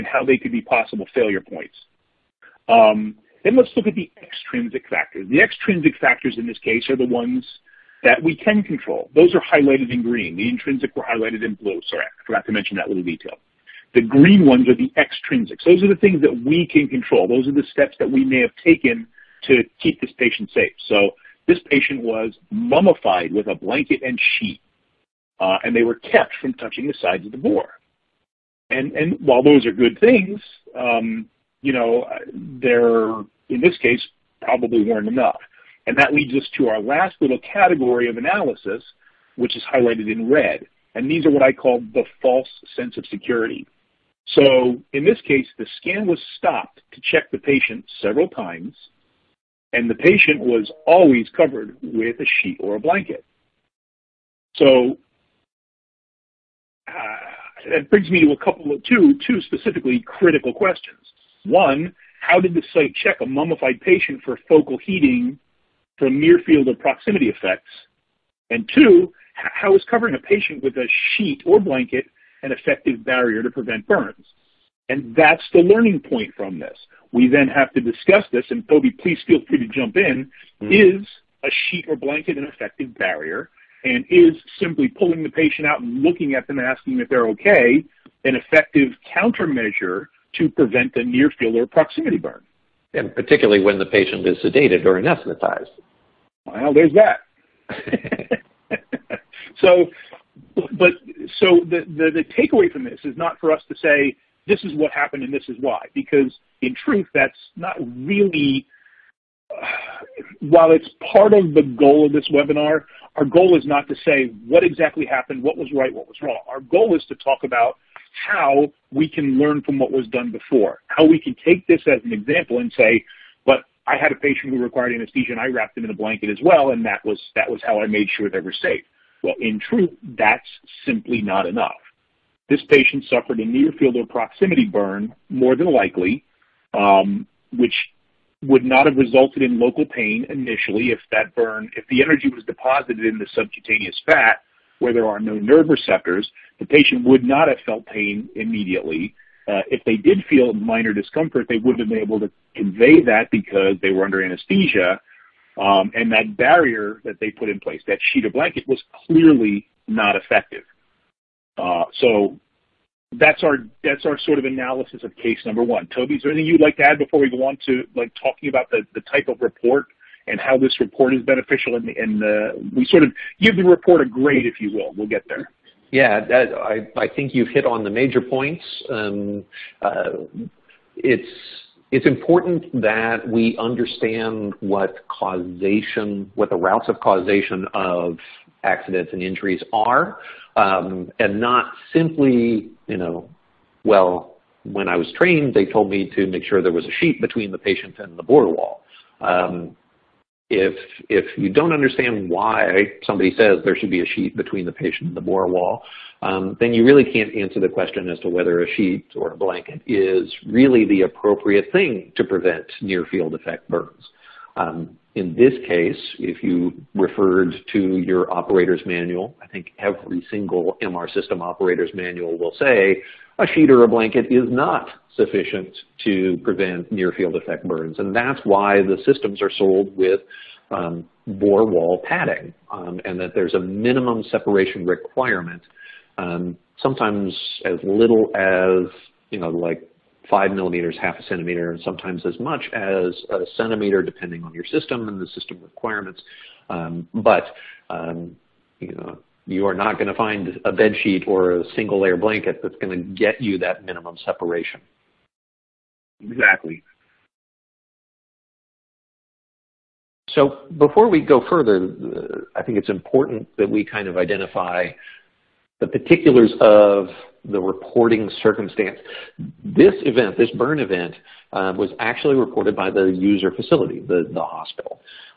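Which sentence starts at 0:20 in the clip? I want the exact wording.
So this patient was mummified with a blanket and sheet, uh, and they were kept from touching the sides of the bore.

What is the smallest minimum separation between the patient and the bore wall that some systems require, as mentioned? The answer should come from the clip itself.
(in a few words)
5 millimeters.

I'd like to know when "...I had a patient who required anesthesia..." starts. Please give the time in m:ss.
2:03.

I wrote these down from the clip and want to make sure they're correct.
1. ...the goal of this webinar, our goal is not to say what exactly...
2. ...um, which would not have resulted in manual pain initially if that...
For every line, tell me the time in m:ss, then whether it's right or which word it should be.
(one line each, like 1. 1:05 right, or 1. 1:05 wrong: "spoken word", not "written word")
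1. 1:51 right
2. 2:16 wrong: "local", not "manual".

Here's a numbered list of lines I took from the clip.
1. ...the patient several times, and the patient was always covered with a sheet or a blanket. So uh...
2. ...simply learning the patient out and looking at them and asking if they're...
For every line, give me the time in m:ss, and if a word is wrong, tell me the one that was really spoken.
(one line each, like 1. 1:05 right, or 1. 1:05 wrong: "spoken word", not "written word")
1. 0:47 right
2. 1:24 wrong: "pulling", not "learning".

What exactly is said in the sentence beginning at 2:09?
Well, in truth, that's simply not enough.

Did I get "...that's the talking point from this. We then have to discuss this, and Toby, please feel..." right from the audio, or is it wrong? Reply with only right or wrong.
wrong.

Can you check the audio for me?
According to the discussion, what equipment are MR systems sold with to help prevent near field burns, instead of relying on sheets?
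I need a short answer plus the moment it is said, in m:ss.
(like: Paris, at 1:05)
Bore wall padding, at 3:51.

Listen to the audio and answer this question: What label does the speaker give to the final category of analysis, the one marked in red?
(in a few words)
False sense of security.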